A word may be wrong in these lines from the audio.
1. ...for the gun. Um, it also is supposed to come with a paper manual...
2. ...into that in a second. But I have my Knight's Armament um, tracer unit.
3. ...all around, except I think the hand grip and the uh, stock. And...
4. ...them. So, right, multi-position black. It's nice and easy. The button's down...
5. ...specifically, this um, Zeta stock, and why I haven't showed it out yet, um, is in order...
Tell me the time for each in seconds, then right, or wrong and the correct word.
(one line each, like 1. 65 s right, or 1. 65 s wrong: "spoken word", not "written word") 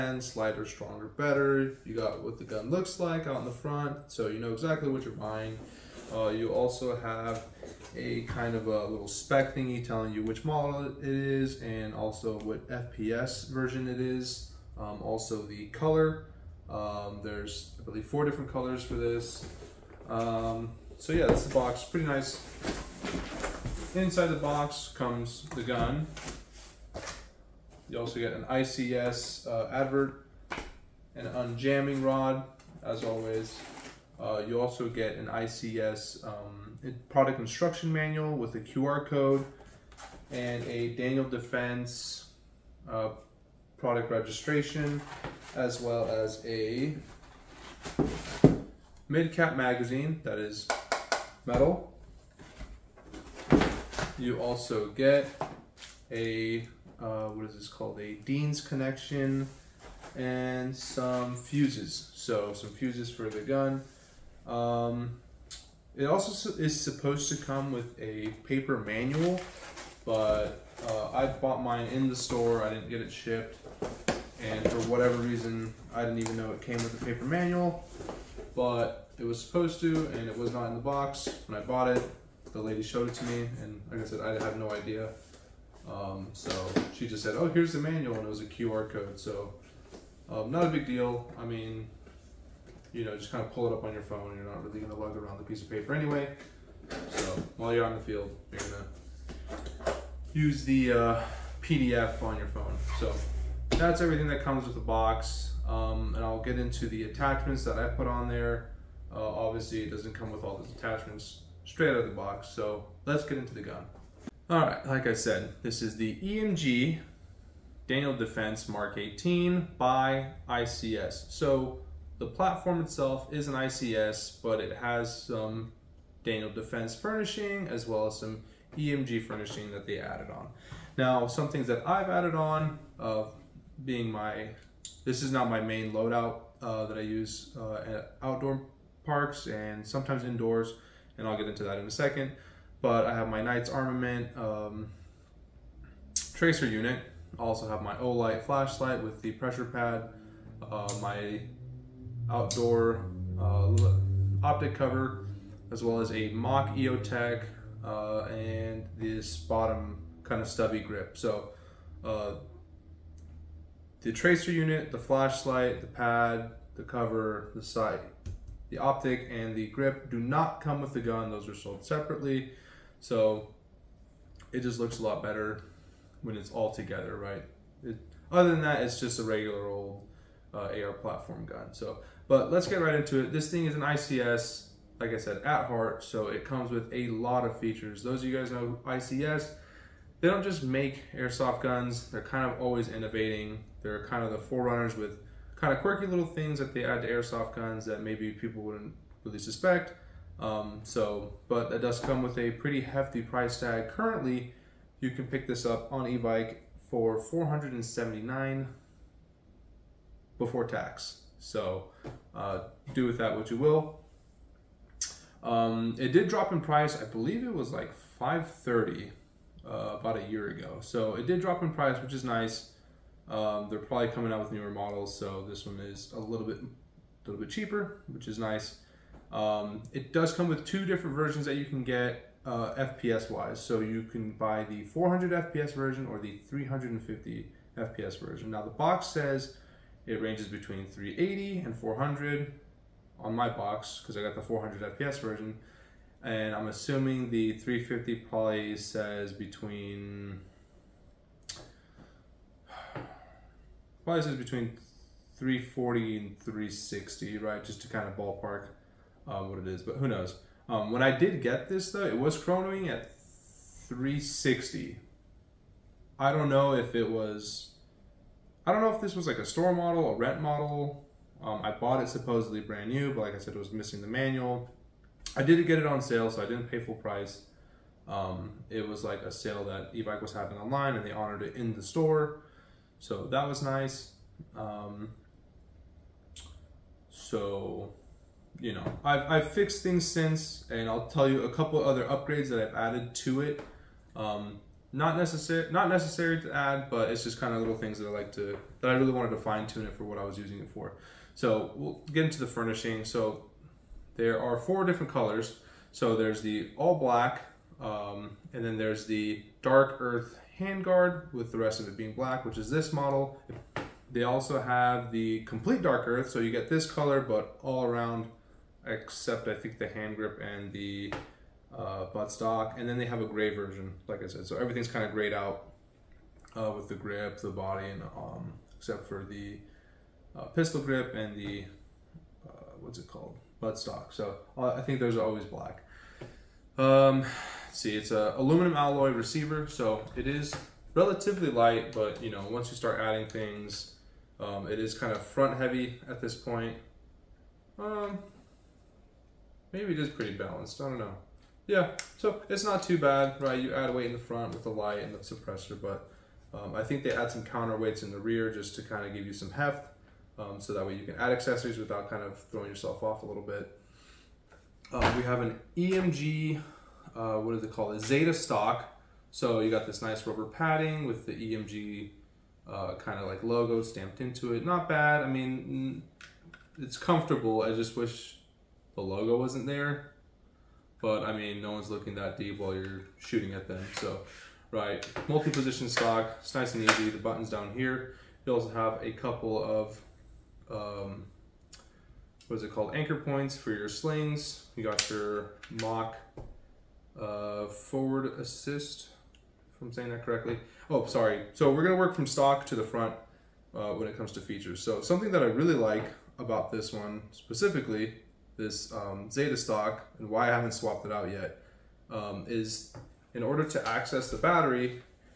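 1. 63 s right
2. 141 s right
3. 317 s wrong: "buttstock", not "stock"
4. 383 s wrong: "stock", not "black"
5. 407 s wrong: "swapped", not "showed".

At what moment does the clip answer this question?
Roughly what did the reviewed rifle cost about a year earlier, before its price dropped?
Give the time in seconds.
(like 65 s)
218 s.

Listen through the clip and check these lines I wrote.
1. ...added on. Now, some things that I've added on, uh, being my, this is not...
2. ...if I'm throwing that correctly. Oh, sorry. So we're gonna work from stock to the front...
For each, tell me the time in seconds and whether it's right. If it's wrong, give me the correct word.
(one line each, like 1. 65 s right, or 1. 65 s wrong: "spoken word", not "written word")
1. 129 s right
2. 399 s wrong: "saying", not "throwing".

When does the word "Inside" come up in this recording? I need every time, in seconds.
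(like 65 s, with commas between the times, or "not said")
23 s.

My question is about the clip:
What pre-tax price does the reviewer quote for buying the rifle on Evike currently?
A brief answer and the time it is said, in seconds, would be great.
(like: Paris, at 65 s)
479, at 207 s.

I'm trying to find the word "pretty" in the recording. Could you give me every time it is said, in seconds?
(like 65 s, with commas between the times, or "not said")
21 s, 202 s, 350 s.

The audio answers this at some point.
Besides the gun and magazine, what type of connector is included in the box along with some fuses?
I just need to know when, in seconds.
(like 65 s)
58 s.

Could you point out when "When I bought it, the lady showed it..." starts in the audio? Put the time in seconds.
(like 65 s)
81 s.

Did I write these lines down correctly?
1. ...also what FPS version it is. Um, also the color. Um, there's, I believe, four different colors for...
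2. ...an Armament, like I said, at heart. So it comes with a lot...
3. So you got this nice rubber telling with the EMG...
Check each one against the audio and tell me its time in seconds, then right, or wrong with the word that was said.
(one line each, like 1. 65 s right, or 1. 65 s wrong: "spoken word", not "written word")
1. 11 s right
2. 183 s wrong: "ICS", not "Armament"
3. 369 s wrong: "padding", not "telling".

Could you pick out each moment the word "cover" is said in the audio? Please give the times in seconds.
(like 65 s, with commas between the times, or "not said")
154 s, 166 s.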